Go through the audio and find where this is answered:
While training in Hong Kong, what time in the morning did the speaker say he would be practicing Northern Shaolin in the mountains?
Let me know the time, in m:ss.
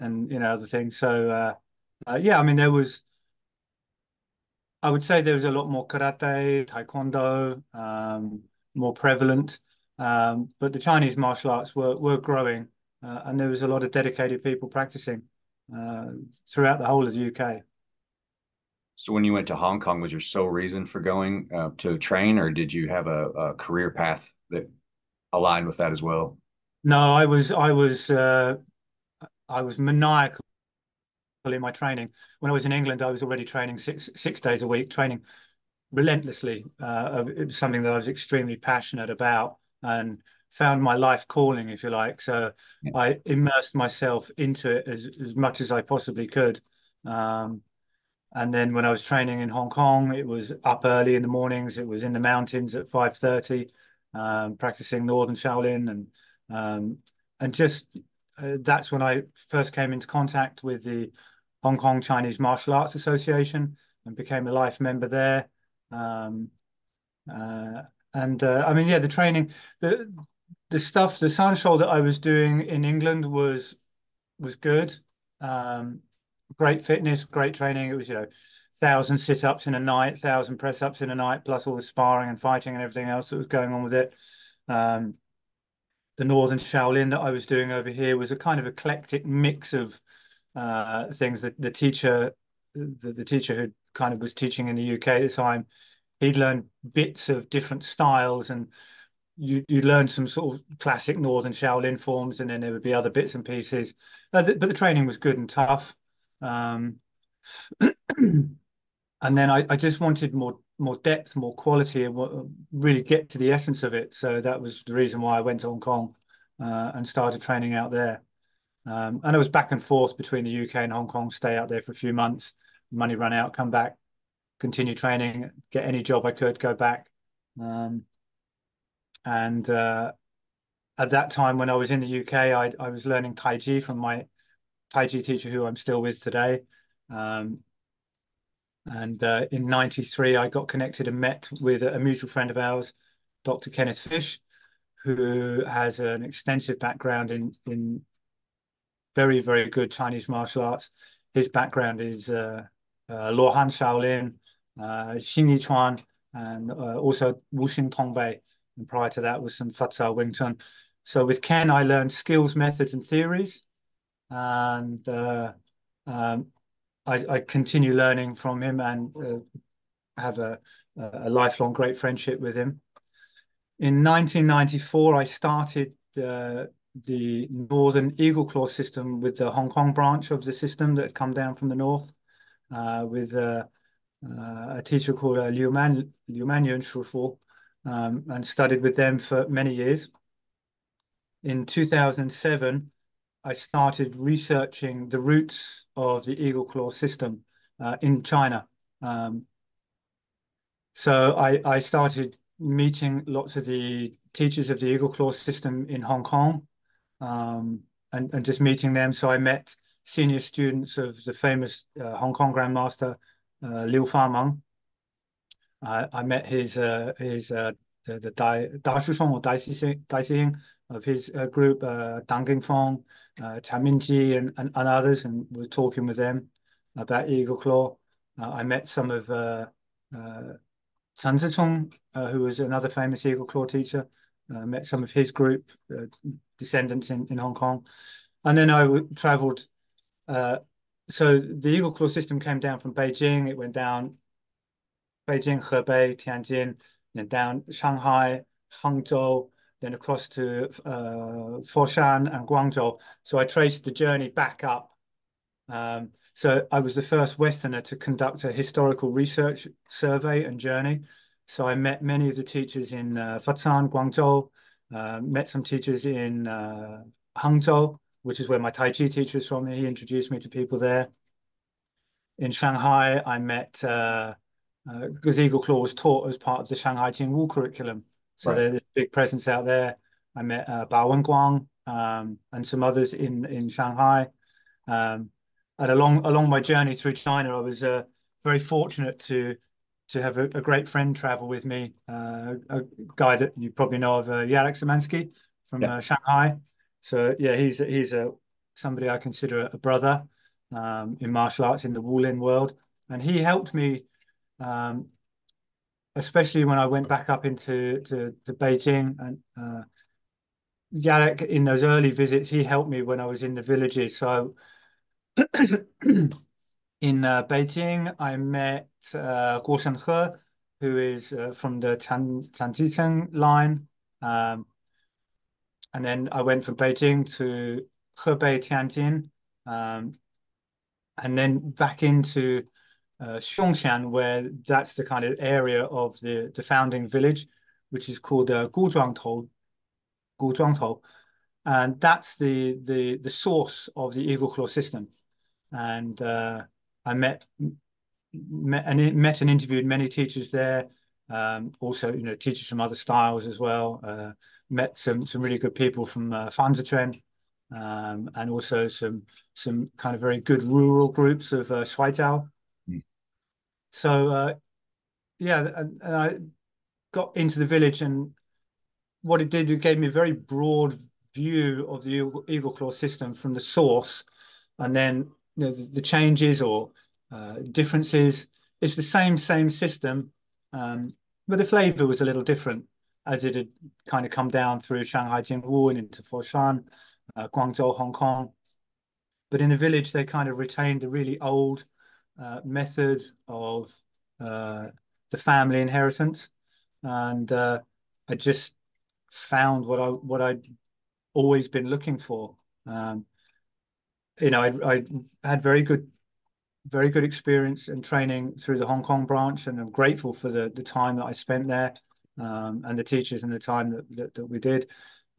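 0:52.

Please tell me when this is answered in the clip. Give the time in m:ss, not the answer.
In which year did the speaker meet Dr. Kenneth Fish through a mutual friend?
2:19.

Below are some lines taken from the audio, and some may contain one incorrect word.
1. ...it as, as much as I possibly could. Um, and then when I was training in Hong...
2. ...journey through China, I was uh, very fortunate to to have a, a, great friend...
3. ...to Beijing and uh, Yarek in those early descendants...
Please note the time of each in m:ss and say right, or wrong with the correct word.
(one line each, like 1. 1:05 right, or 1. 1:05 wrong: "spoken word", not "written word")
1. 0:44 right
2. 4:46 right
3. 5:08 wrong: "visits", not "descendants".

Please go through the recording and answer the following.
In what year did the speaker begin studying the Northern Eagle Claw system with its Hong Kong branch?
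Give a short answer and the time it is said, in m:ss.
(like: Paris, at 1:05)
1994, at 2:54.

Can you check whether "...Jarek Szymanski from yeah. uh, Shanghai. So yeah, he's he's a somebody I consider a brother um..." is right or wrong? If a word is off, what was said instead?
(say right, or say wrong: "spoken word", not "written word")
right.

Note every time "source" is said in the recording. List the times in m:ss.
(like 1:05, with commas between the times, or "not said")
5:43, 6:13.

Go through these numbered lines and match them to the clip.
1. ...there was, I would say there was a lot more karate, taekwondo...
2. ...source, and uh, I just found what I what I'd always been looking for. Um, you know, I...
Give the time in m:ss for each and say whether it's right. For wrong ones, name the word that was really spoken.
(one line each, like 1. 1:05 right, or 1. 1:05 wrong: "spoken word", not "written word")
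1. 0:02 right
2. 6:35 wrong: "inheritance", not "source".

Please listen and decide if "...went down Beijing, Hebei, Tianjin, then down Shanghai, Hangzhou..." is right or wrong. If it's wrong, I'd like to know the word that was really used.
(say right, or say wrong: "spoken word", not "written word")
right.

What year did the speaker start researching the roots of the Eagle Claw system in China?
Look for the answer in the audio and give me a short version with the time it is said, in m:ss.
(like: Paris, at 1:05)
2007, at 3:11.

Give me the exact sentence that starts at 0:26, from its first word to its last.
No, I was I was uh, I was maniacal in my training.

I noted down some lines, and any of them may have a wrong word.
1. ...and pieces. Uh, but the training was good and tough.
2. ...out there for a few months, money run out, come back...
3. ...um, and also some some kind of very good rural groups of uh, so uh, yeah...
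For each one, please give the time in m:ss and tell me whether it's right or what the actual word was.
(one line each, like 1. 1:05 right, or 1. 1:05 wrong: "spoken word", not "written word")
1. 1:43 right
2. 2:01 right
3. 5:57 right.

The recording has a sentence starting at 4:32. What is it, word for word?
In Shanghai, I met uh, because uh, Eagle Claw was taught as part of the Shanghai Jingwu curriculum.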